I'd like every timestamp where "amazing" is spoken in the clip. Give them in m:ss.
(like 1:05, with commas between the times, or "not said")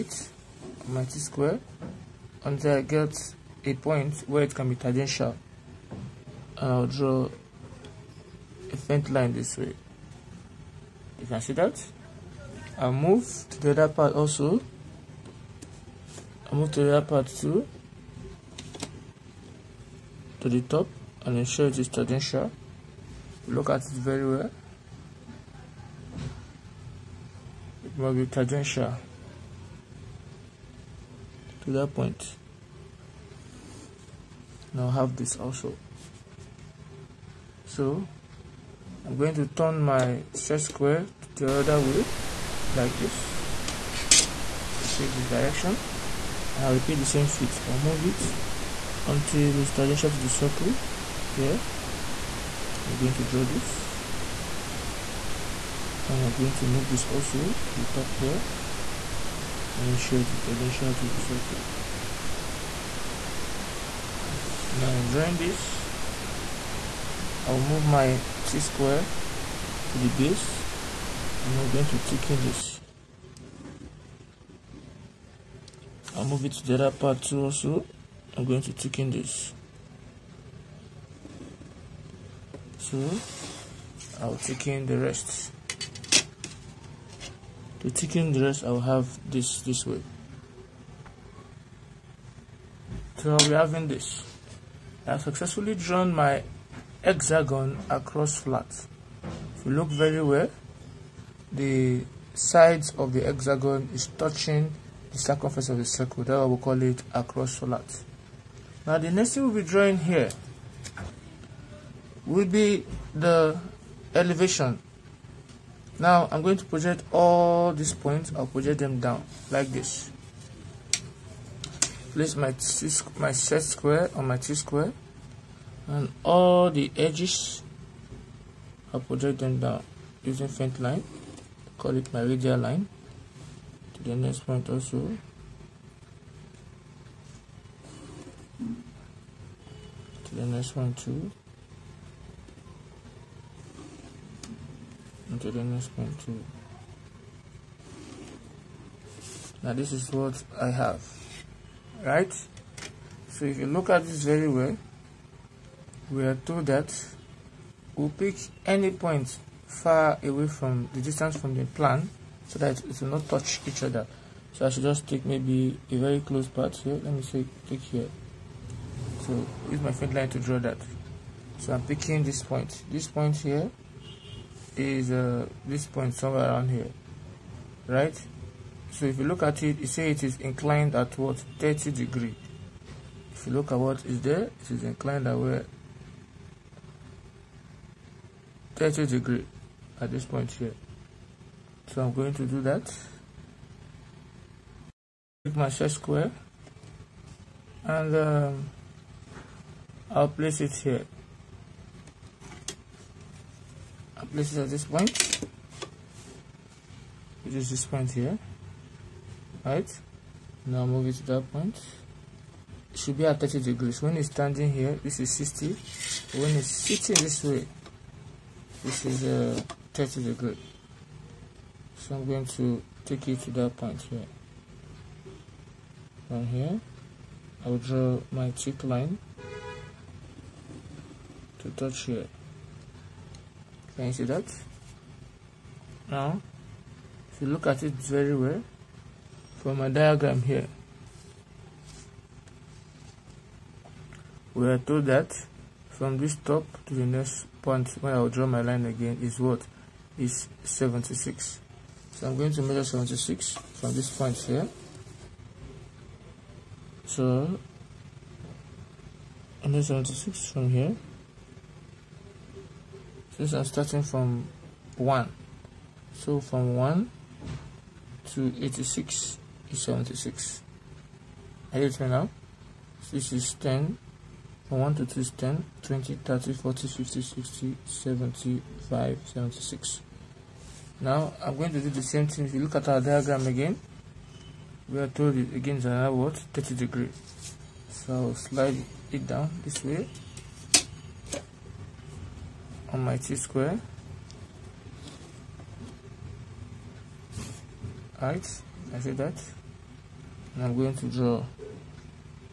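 not said.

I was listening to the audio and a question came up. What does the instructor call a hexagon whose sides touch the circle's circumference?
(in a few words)
across flats.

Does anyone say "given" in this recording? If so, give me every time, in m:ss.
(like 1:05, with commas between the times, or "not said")
not said.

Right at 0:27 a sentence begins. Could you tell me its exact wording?
It must be tangential to that point.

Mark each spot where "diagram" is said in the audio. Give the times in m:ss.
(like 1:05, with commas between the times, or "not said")
3:59, 4:42.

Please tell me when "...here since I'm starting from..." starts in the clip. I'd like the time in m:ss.
4:20.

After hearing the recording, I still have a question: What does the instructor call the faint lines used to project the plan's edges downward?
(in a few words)
radial line.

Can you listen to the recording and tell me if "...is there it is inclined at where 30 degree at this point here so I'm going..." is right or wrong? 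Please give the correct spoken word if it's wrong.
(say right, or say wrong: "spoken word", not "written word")
right.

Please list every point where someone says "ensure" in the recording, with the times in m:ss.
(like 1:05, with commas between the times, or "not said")
0:21.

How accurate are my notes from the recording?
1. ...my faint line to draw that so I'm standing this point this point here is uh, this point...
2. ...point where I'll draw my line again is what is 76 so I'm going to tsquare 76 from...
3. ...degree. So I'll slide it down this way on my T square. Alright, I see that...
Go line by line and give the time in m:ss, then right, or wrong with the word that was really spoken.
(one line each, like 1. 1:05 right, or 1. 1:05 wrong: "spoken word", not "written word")
1. 2:49 wrong: "picking", not "standing"
2. 4:07 wrong: "measure", not "tsquare"
3. 4:46 right.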